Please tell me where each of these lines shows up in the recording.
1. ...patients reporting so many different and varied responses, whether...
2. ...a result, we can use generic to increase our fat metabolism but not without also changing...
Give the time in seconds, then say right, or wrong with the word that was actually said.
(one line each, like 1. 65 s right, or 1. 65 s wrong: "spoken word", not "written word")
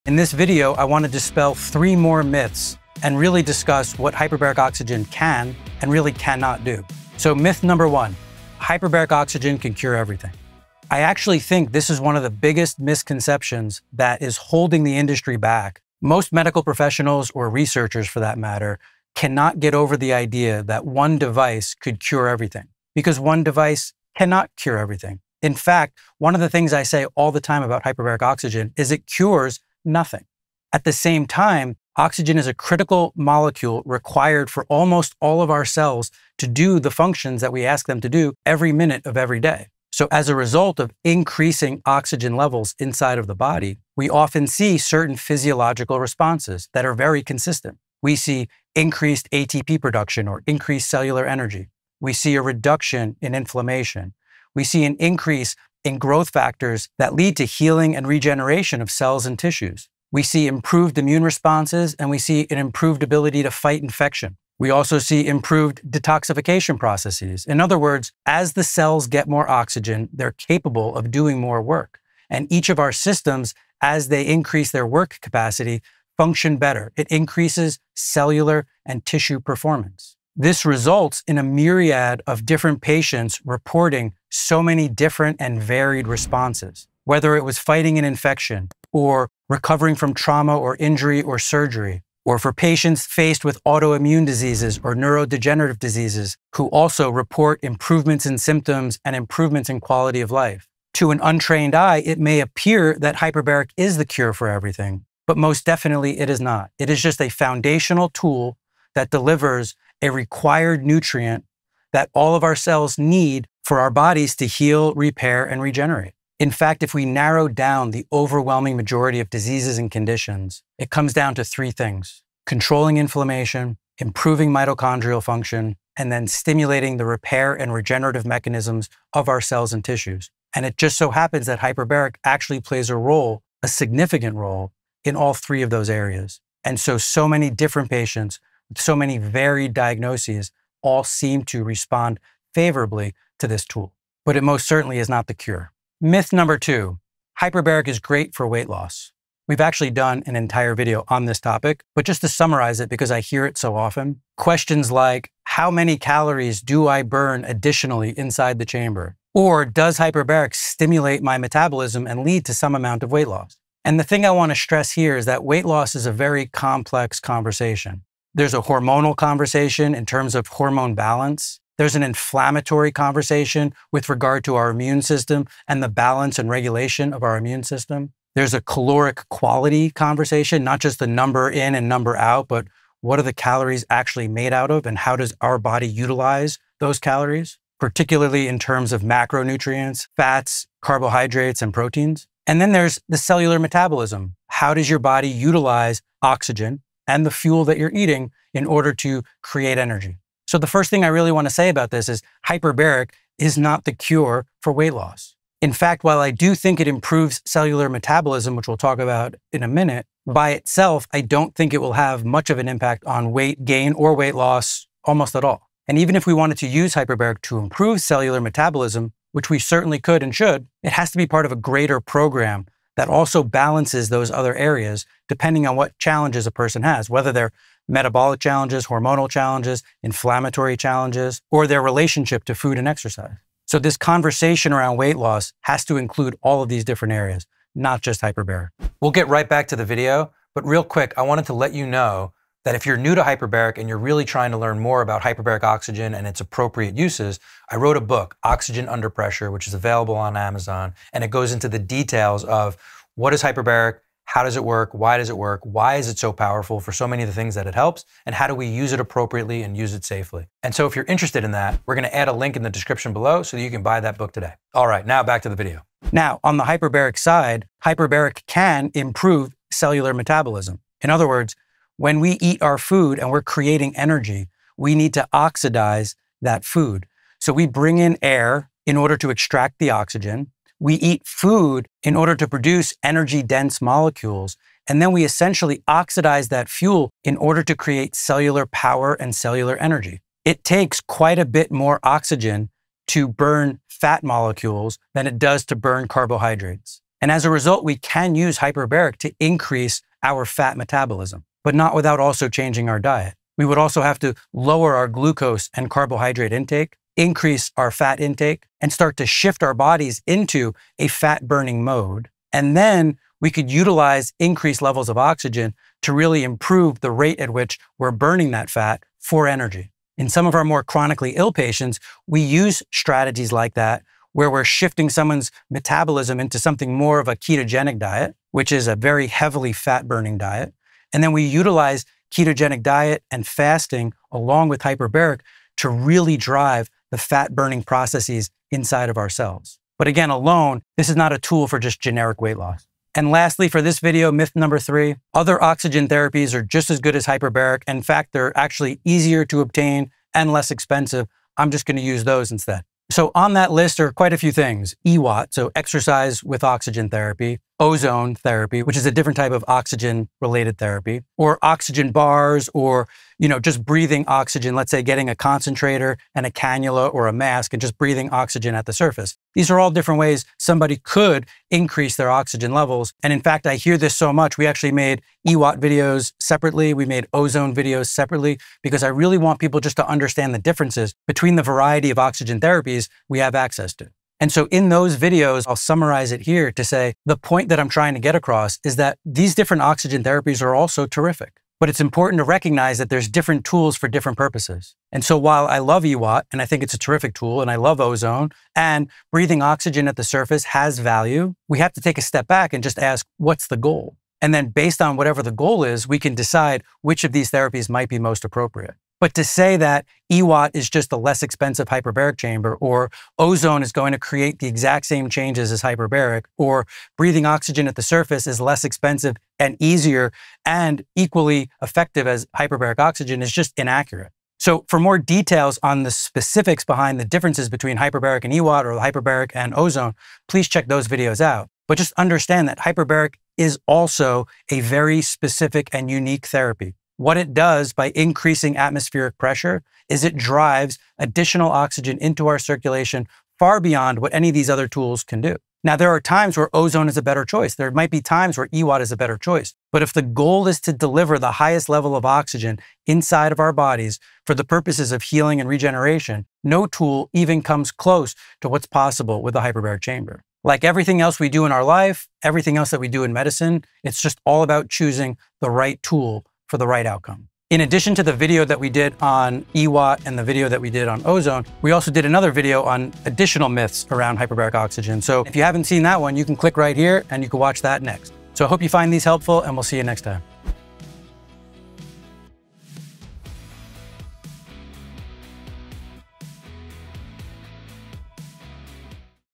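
1. 82 s right
2. 297 s wrong: "hyperbaric", not "generic".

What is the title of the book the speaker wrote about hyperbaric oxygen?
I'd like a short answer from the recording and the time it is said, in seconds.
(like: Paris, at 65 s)
Oxygen Under Pressure, at 248 s.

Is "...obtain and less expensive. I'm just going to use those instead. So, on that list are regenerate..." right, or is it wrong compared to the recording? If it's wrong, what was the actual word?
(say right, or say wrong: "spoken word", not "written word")
wrong: "quite", not "regenerate".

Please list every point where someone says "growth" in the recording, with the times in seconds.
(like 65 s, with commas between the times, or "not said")
55 s.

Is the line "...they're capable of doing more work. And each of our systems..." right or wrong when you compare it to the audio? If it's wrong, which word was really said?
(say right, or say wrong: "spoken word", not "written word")
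right.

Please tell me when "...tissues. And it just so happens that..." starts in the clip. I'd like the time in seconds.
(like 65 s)
129 s.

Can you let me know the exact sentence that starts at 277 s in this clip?
So we bring in air in order to extract the oxygen.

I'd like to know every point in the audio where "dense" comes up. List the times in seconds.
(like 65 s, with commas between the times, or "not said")
283 s.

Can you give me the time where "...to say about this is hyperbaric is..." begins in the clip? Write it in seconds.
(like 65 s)
201 s.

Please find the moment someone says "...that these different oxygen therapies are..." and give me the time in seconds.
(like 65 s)
388 s.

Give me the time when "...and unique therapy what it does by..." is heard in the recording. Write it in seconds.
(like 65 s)
435 s.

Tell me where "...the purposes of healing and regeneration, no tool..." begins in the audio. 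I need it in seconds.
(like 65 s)
454 s.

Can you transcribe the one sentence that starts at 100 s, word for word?
To an untrained eye, it may appear that hyperbaric is the cure for everything, but most definitely it is not.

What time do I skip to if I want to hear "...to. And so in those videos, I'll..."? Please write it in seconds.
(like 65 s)
383 s.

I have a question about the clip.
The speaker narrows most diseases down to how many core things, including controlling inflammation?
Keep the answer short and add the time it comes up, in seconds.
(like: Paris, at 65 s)
3, at 121 s.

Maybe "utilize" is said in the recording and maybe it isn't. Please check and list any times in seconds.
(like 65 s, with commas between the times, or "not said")
185 s, 195 s, 313 s, 331 s.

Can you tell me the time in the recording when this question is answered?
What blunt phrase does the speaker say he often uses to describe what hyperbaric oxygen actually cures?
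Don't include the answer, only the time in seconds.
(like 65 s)
28 s.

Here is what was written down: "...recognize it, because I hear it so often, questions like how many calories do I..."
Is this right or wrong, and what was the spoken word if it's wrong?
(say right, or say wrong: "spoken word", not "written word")
wrong: "summarize", not "recognize".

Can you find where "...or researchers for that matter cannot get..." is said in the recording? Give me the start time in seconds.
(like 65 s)
17 s.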